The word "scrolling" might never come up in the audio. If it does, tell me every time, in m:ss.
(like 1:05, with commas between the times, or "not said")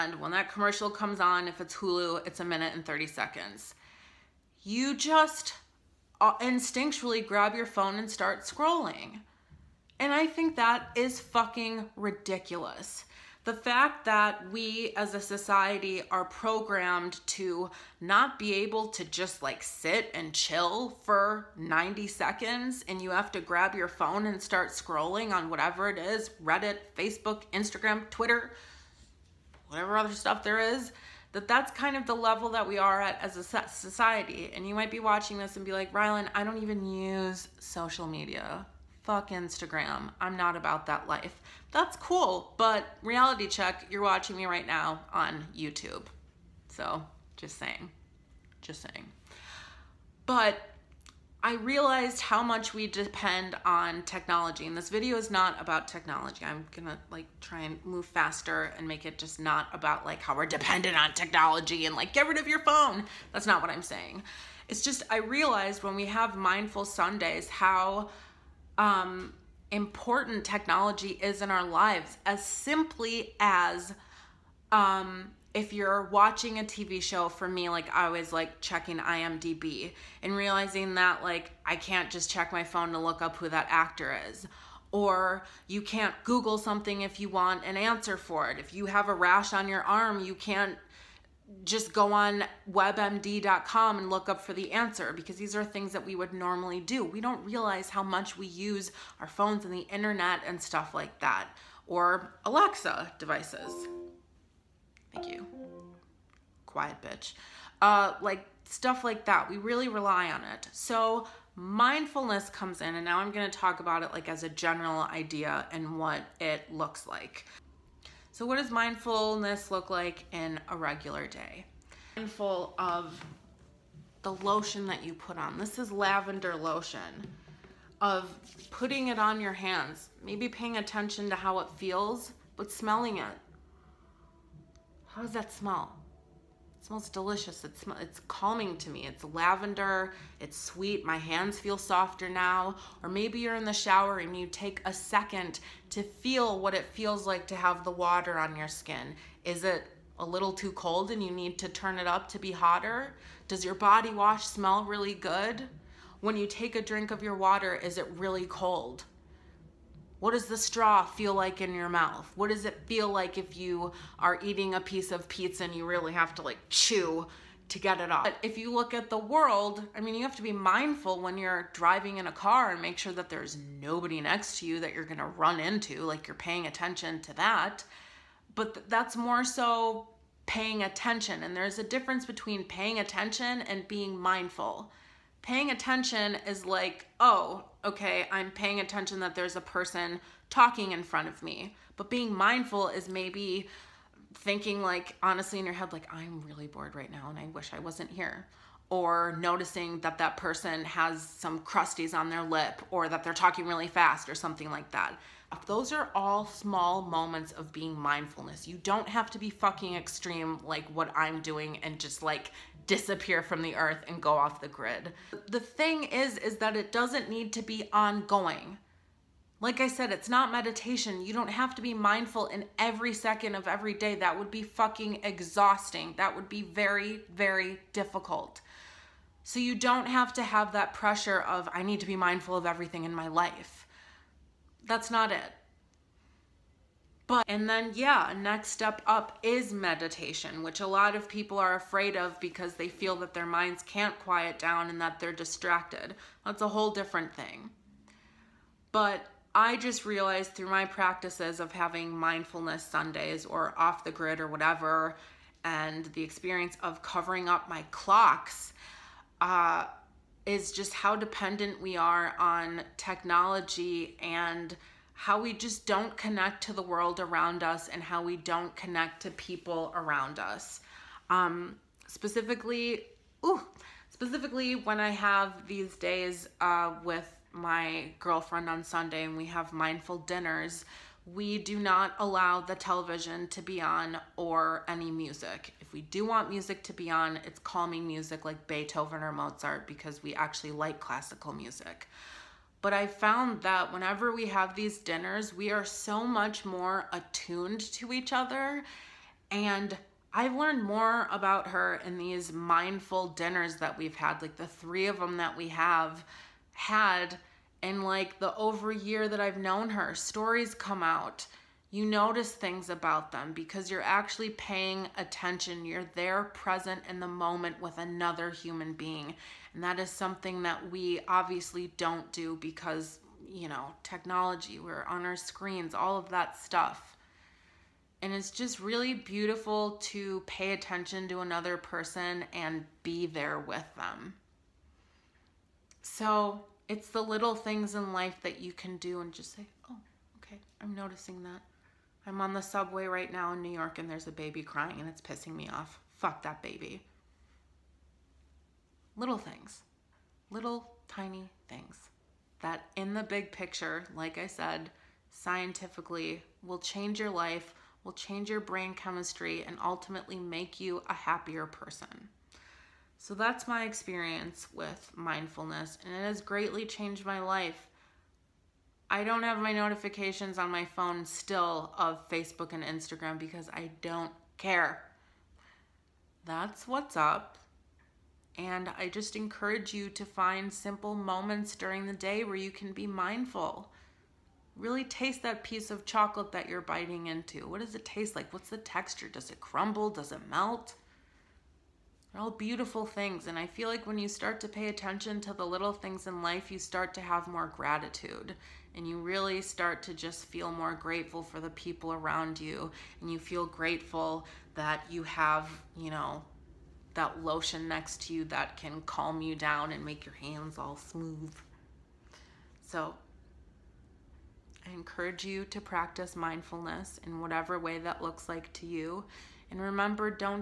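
0:08, 0:24.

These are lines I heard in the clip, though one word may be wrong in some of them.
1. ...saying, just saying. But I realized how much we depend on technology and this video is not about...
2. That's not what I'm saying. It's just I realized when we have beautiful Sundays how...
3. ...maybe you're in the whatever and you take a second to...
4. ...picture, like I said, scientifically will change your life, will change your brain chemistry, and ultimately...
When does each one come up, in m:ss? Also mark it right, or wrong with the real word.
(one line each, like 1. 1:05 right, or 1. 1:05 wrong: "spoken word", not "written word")
1. 0:47 right
2. 1:03 wrong: "mindful", not "beautiful"
3. 2:23 wrong: "shower", not "whatever"
4. 5:53 right.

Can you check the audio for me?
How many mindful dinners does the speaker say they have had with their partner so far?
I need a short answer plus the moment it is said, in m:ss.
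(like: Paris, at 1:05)
3, at 5:04.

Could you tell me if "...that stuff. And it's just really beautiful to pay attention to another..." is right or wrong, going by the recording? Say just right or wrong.
right.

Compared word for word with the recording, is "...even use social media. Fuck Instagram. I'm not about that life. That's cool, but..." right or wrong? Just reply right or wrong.
right.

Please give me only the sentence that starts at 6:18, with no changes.
And I just encourage you to find simple moments during the day where you can be mindful.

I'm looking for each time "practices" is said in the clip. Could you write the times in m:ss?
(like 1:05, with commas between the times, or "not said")
4:10, 6:55.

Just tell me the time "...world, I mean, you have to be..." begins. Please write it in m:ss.
2:49.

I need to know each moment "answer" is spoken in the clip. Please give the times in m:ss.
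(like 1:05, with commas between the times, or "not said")
1:27, 1:34.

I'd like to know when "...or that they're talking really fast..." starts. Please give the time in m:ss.
3:22.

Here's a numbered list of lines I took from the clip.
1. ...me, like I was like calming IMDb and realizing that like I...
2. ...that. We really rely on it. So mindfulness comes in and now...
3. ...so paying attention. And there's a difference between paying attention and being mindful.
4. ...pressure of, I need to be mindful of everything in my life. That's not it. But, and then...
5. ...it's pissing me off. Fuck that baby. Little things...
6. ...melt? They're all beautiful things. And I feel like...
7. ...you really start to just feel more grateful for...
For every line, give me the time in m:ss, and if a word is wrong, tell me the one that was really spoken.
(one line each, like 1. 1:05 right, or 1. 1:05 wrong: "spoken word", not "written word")
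1. 1:17 wrong: "checking", not "calming"
2. 1:49 right
3. 2:59 right
4. 3:50 right
5. 5:45 right
6. 6:30 right
7. 6:39 right.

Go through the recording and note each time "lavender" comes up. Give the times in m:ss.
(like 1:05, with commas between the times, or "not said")
2:05, 2:19.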